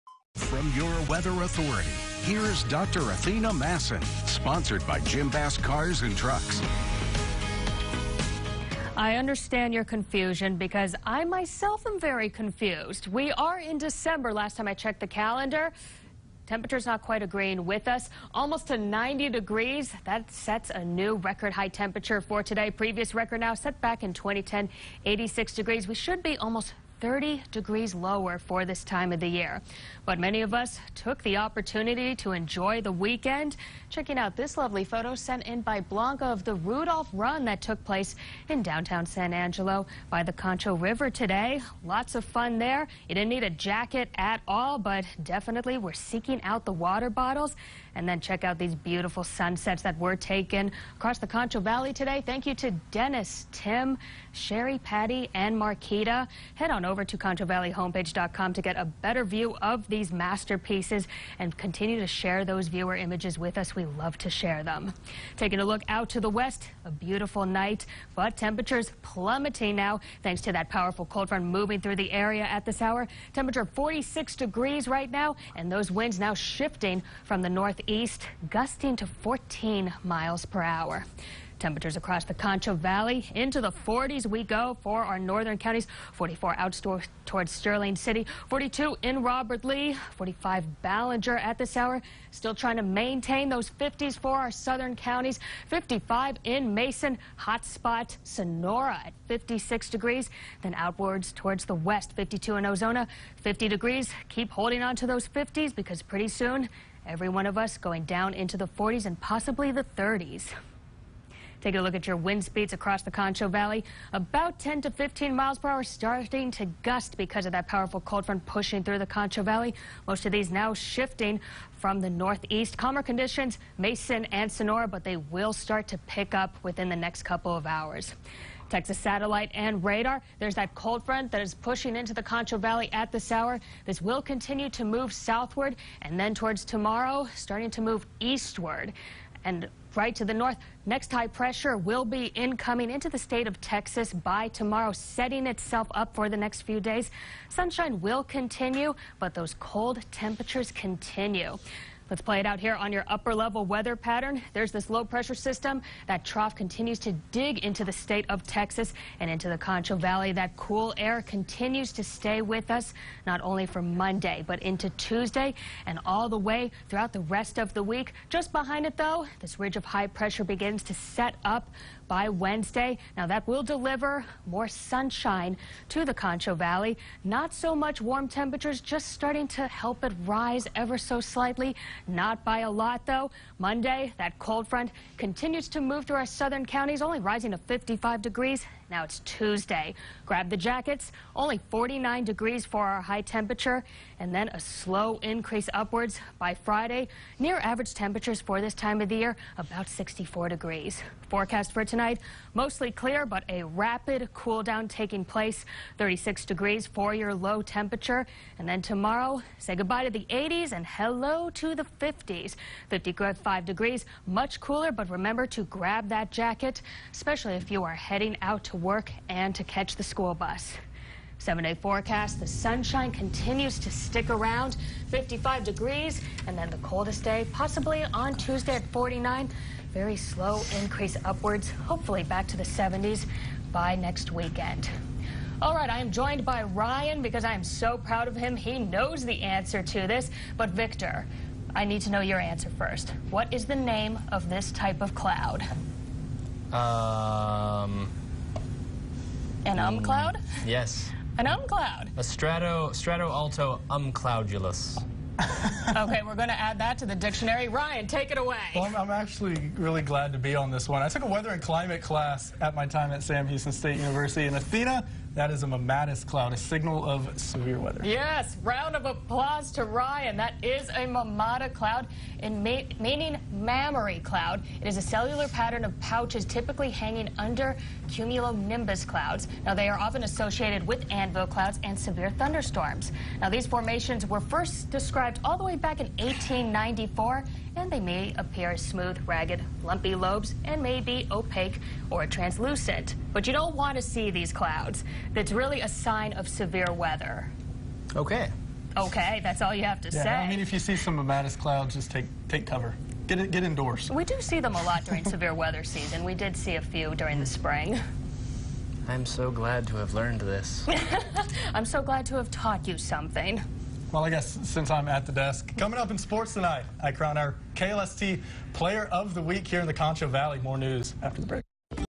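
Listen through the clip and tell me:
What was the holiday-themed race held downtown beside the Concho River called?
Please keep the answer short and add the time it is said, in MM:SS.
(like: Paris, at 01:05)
Rudolph Run, at 00:36.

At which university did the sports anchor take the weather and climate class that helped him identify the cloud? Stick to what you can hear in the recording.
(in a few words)
Sam Houston State University.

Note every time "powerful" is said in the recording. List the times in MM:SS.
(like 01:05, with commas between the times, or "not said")
01:10, 01:57.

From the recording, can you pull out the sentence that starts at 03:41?
Seven day forecast, the sunshine continues to stick around, 55 degrees, and then the coldest day, possibly on Tuesday at 49.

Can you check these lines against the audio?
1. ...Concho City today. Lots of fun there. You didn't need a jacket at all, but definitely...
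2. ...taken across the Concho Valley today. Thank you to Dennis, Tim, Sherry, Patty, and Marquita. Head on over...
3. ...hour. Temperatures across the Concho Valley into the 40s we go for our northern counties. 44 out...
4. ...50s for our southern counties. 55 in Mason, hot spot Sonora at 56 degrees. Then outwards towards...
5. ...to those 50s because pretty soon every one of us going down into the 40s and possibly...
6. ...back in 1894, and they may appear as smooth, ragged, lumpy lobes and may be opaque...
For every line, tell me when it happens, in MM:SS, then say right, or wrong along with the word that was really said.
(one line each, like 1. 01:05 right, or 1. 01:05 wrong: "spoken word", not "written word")
1. 00:40 wrong: "River", not "City"
2. 00:50 right
3. 01:20 right
4. 01:33 right
5. 01:44 right
6. 04:45 right.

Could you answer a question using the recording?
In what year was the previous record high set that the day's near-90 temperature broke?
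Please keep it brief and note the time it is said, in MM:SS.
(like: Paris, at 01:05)
2010, at 00:24.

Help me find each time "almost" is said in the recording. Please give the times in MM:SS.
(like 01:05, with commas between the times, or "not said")
00:18, 00:26.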